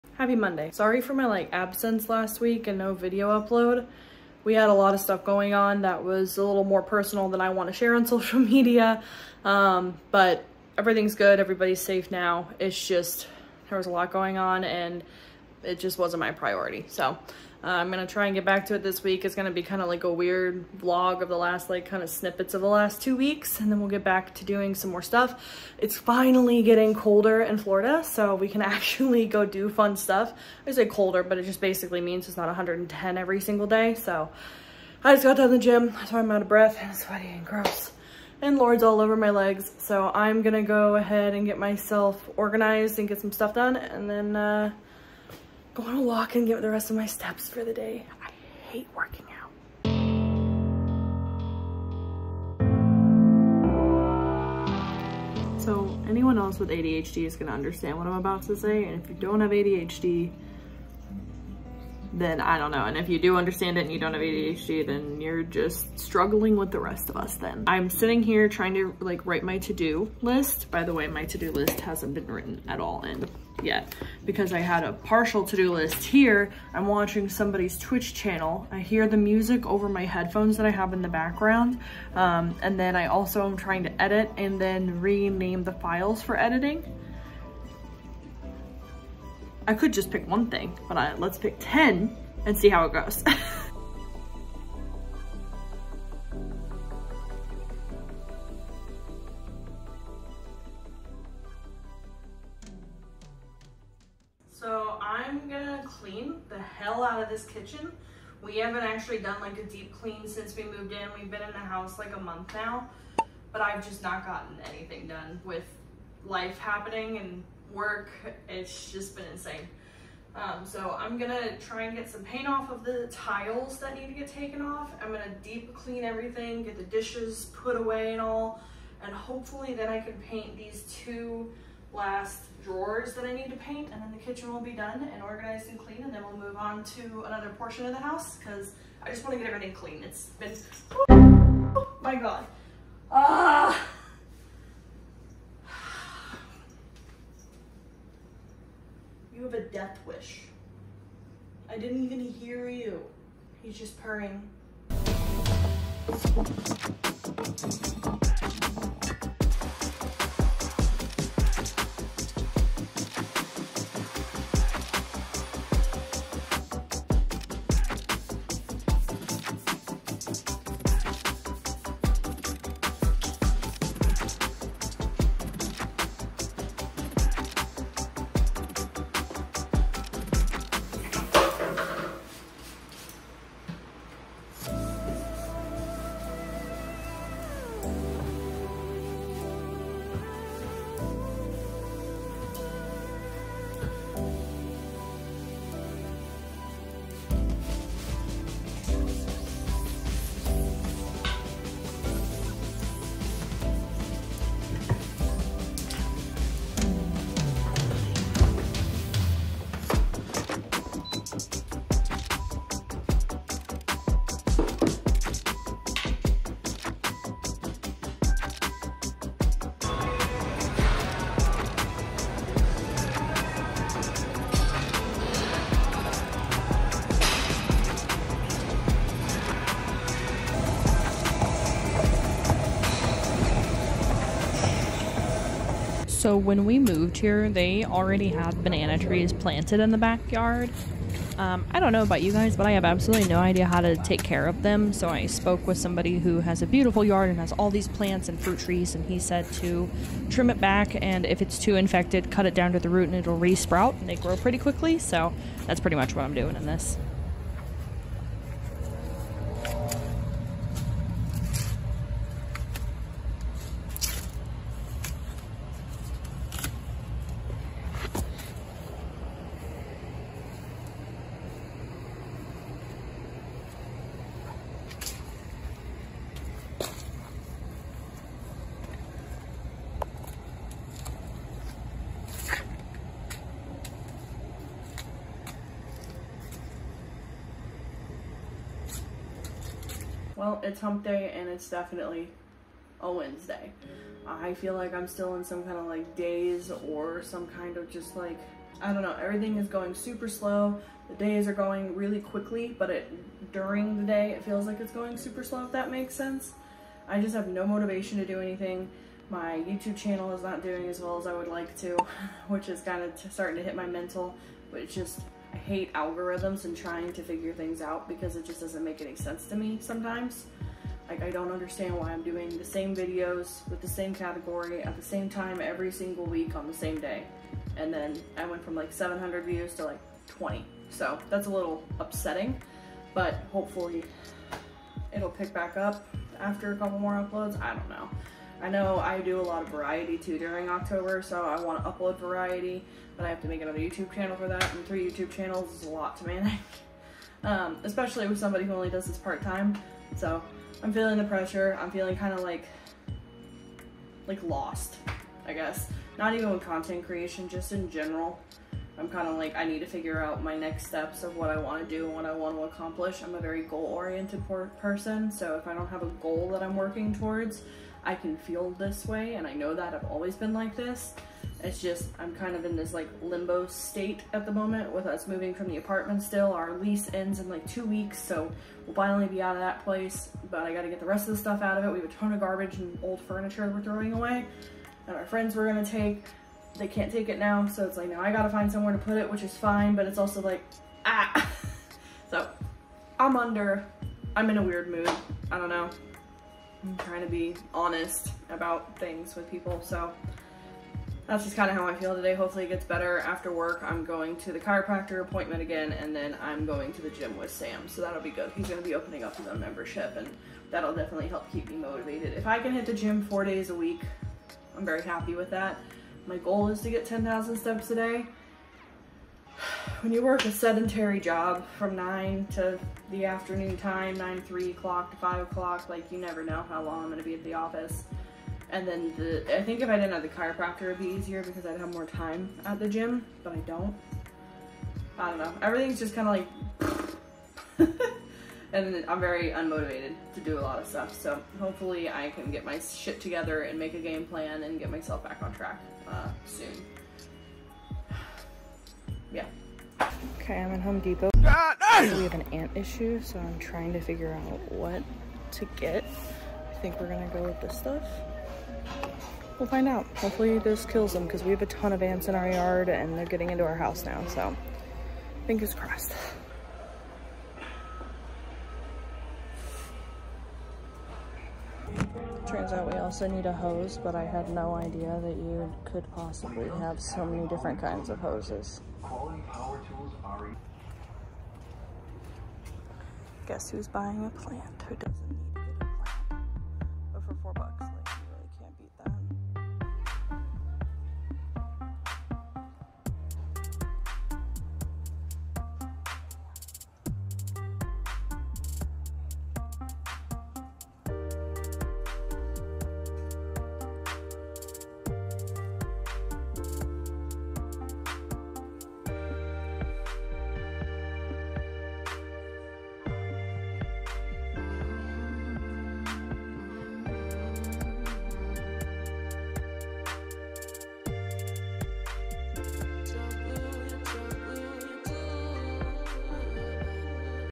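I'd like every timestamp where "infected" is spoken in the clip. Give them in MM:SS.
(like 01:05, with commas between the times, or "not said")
04:11.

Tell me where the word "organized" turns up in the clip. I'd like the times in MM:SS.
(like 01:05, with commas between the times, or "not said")
00:42, 02:15.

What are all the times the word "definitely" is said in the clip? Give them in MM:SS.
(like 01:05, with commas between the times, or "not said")
04:51, 06:50.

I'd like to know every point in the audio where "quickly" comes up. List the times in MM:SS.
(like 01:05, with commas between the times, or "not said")
04:14, 05:02.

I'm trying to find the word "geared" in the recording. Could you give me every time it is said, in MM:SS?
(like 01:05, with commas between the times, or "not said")
not said.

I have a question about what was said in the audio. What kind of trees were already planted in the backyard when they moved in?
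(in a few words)
banana trees.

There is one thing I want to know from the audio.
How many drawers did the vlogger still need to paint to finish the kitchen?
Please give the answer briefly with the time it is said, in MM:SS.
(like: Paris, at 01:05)
2, at 02:10.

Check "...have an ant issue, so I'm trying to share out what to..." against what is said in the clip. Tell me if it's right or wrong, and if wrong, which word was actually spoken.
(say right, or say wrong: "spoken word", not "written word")
wrong: "figure", not "share".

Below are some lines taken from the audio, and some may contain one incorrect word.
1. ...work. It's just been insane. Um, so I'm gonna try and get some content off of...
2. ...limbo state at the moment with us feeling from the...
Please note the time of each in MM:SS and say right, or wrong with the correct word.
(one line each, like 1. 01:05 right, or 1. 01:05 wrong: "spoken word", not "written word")
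1. 01:57 wrong: "paint", not "content"
2. 06:13 wrong: "moving", not "feeling".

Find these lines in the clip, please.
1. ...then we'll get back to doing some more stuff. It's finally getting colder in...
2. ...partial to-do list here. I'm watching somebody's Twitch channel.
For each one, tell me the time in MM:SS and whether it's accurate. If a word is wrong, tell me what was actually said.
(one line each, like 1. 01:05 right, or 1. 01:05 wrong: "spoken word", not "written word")
1. 00:23 right
2. 01:14 right.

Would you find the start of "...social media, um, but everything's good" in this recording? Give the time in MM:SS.
00:08.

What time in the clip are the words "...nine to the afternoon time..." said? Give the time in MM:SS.
07:01.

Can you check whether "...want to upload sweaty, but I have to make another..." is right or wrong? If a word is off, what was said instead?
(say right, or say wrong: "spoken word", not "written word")
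wrong: "variety", not "sweaty".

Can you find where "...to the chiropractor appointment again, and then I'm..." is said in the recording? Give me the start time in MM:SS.
06:44.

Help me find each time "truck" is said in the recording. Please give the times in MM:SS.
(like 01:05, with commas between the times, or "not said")
not said.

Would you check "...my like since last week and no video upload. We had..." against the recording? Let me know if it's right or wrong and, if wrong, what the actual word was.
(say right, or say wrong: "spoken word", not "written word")
wrong: "absence", not "since".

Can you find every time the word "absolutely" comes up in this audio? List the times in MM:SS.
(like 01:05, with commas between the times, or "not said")
04:02.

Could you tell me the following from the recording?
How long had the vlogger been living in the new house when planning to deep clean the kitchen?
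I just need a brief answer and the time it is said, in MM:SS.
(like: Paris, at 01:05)
a month, at 01:51.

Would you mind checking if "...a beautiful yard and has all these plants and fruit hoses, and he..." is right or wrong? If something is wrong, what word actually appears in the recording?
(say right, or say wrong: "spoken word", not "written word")
wrong: "trees", not "hoses".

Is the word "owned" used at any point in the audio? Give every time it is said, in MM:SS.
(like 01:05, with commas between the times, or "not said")
not said.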